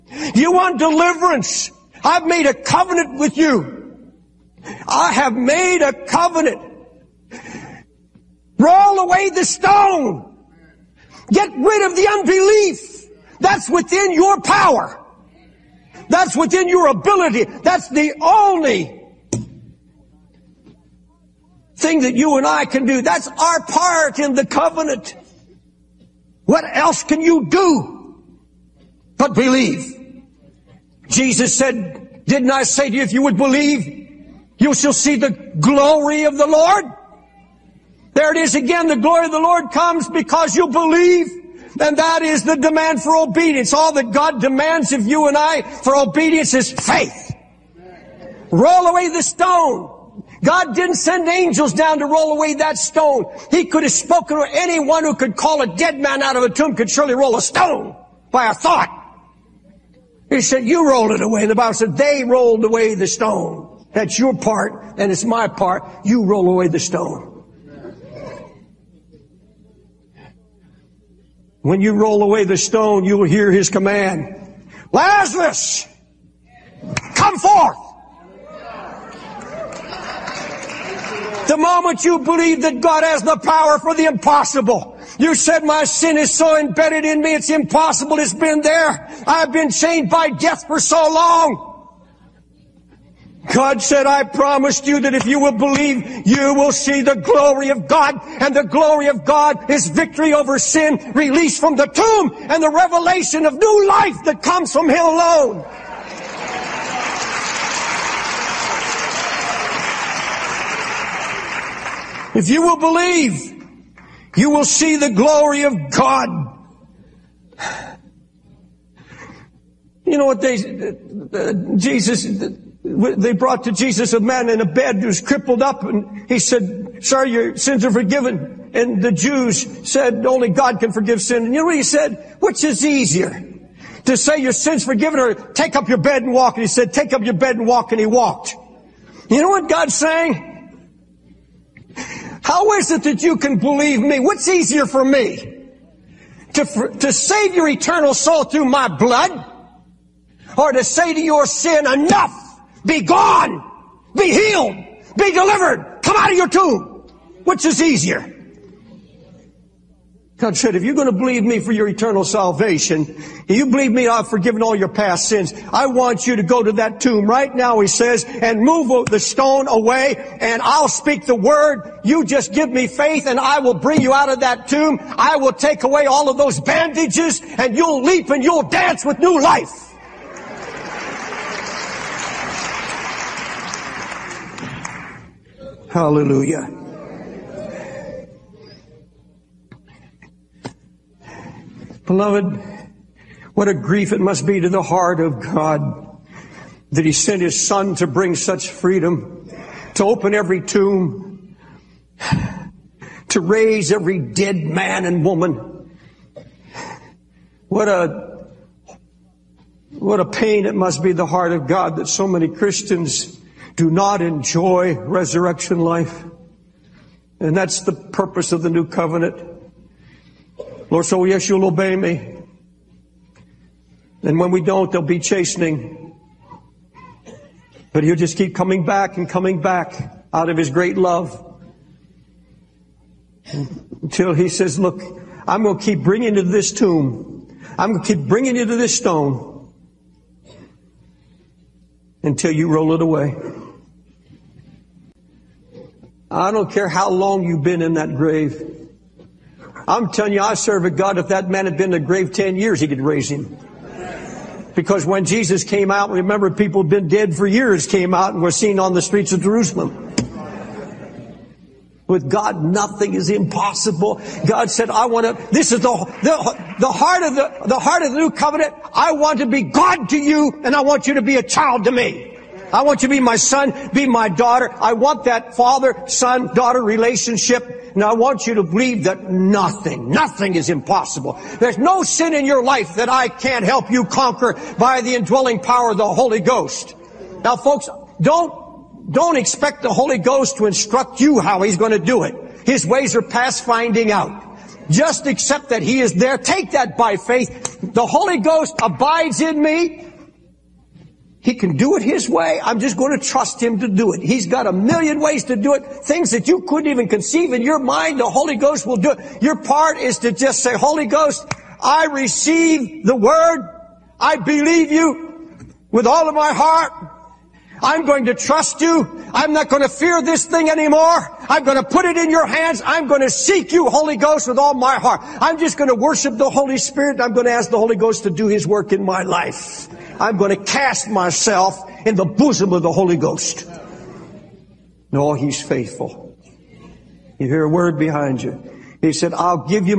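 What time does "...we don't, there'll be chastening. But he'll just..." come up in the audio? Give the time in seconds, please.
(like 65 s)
224 s.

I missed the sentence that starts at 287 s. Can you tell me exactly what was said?
Now folks, don't, don't expect the Holy Ghost to instruct you how He's going to do it.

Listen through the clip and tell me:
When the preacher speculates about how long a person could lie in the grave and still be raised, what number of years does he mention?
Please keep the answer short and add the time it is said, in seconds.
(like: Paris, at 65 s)
10, at 252 s.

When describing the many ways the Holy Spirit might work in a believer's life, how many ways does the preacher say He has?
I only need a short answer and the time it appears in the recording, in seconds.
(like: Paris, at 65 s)
a million, at 304 s.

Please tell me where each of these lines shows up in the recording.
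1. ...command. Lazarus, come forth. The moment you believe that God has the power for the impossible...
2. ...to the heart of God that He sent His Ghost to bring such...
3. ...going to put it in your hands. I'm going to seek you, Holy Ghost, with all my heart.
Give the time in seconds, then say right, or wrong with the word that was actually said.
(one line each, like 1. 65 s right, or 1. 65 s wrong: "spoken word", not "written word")
1. 73 s right
2. 194 s wrong: "Son", not "Ghost"
3. 321 s right.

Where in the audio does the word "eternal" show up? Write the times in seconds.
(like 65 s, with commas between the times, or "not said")
147 s, 161 s.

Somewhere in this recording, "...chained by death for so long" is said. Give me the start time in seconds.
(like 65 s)
89 s.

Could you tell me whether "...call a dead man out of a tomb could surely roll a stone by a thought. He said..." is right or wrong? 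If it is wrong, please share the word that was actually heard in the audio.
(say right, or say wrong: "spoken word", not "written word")
right.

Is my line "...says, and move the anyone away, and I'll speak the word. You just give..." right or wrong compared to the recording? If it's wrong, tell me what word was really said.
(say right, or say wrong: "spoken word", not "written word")
wrong: "stone", not "anyone".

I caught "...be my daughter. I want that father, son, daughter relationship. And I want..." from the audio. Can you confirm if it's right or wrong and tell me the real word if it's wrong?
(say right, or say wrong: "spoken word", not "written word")
right.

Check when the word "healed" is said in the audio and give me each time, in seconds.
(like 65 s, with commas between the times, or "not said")
154 s.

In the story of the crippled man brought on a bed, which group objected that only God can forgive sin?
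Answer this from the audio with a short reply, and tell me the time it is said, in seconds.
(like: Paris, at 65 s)
the Jews, at 129 s.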